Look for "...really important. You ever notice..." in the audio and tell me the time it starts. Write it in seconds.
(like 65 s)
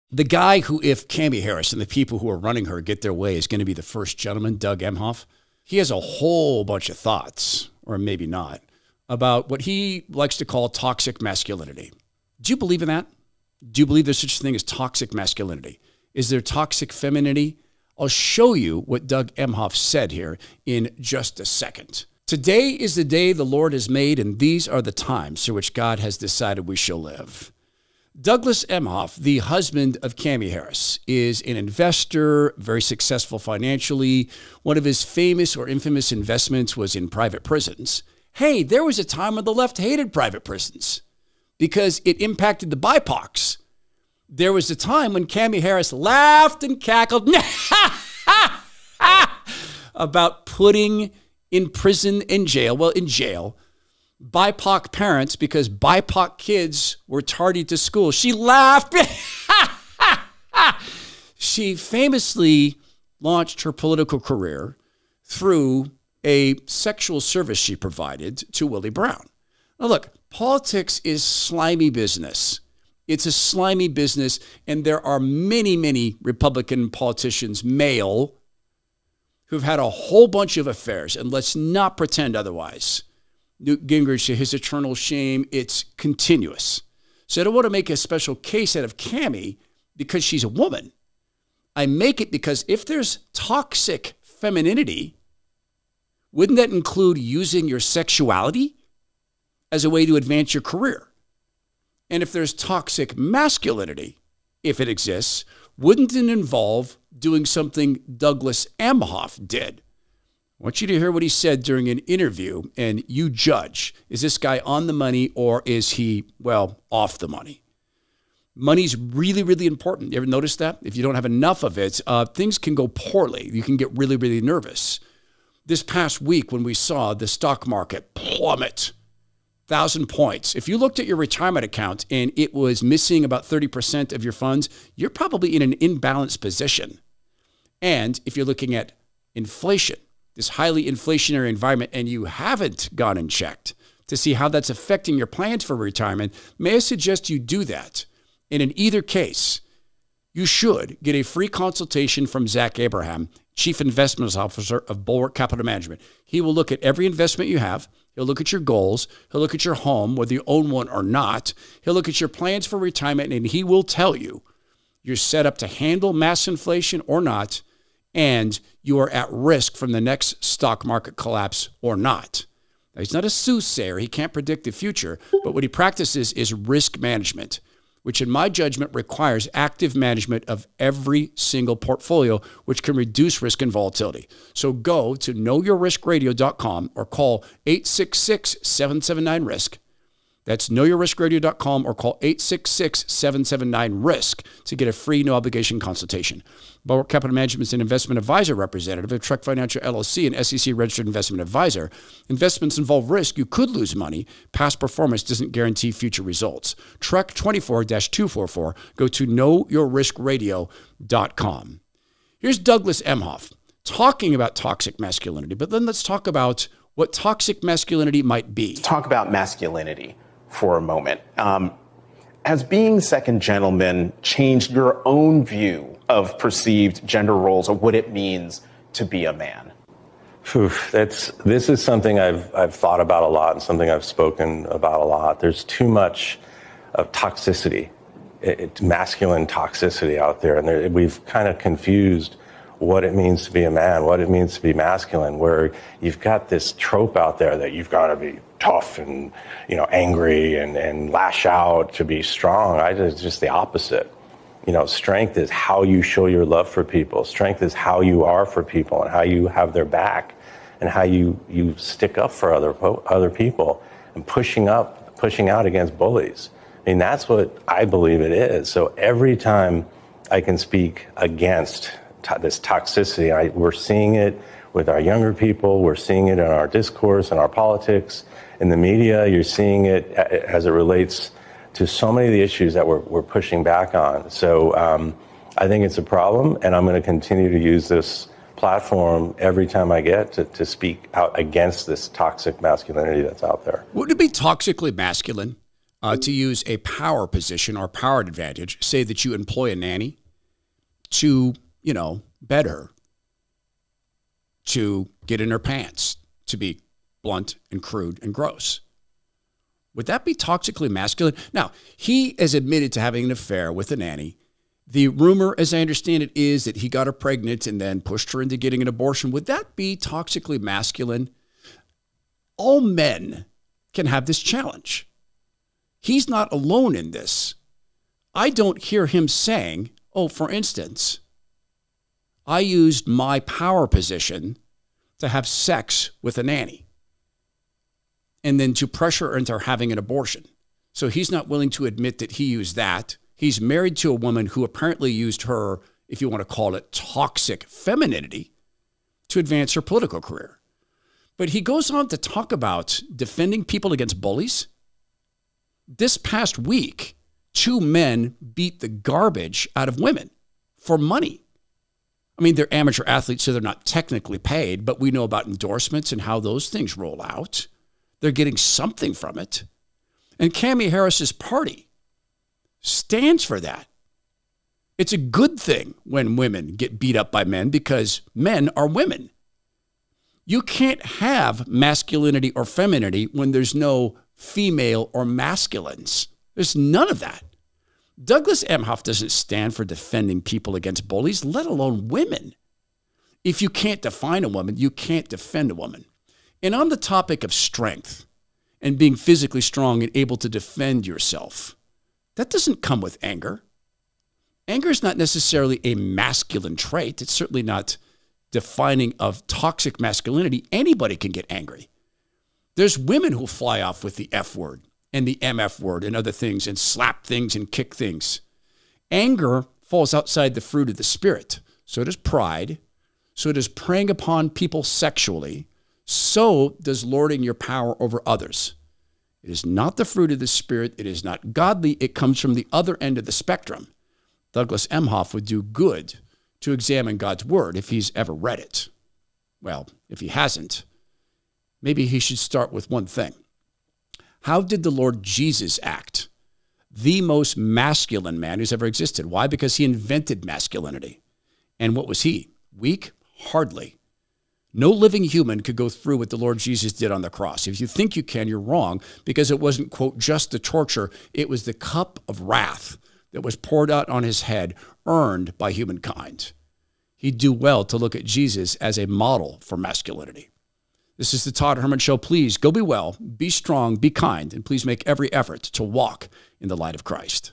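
119 s.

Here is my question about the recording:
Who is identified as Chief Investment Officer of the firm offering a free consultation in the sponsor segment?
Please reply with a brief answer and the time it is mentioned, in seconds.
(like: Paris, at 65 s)
Zach Abraham, at 152 s.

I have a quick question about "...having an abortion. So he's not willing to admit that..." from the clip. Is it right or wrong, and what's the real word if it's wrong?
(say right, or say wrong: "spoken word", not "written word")
right.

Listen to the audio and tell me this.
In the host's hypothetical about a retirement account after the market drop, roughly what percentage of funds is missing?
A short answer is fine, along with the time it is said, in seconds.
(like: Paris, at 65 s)
30%, at 133 s.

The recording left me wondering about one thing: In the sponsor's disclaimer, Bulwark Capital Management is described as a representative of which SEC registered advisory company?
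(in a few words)
Trek Financial LLC.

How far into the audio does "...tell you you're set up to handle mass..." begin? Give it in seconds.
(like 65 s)
163 s.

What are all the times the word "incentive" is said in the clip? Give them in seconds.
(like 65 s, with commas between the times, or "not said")
not said.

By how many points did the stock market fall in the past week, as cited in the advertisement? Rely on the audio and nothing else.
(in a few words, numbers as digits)
1000.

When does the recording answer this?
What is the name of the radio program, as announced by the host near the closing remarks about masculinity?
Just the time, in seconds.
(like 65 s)
471 s.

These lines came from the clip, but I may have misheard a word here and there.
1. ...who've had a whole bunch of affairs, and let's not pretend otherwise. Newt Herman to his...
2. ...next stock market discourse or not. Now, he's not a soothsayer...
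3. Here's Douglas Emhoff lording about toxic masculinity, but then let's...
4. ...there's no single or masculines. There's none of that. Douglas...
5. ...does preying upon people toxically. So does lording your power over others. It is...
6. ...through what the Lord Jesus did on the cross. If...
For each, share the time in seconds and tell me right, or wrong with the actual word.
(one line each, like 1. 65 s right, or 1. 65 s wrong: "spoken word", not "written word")
1. 79 s wrong: "Gingrich", not "Herman"
2. 170 s wrong: "collapse", not "discourse"
3. 212 s wrong: "talking", not "lording"
4. 383 s wrong: "female", not "single"
5. 423 s wrong: "sexually", not "toxically"
6. 455 s right.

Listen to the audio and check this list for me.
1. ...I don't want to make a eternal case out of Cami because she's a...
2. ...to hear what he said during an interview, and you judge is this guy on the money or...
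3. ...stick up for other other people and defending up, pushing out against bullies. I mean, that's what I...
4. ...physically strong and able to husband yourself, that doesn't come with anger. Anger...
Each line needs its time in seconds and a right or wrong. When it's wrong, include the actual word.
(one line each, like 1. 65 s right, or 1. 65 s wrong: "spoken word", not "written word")
1. 87 s wrong: "special", not "eternal"
2. 110 s right
3. 261 s wrong: "pushing", not "defending"
4. 399 s wrong: "defend", not "husband".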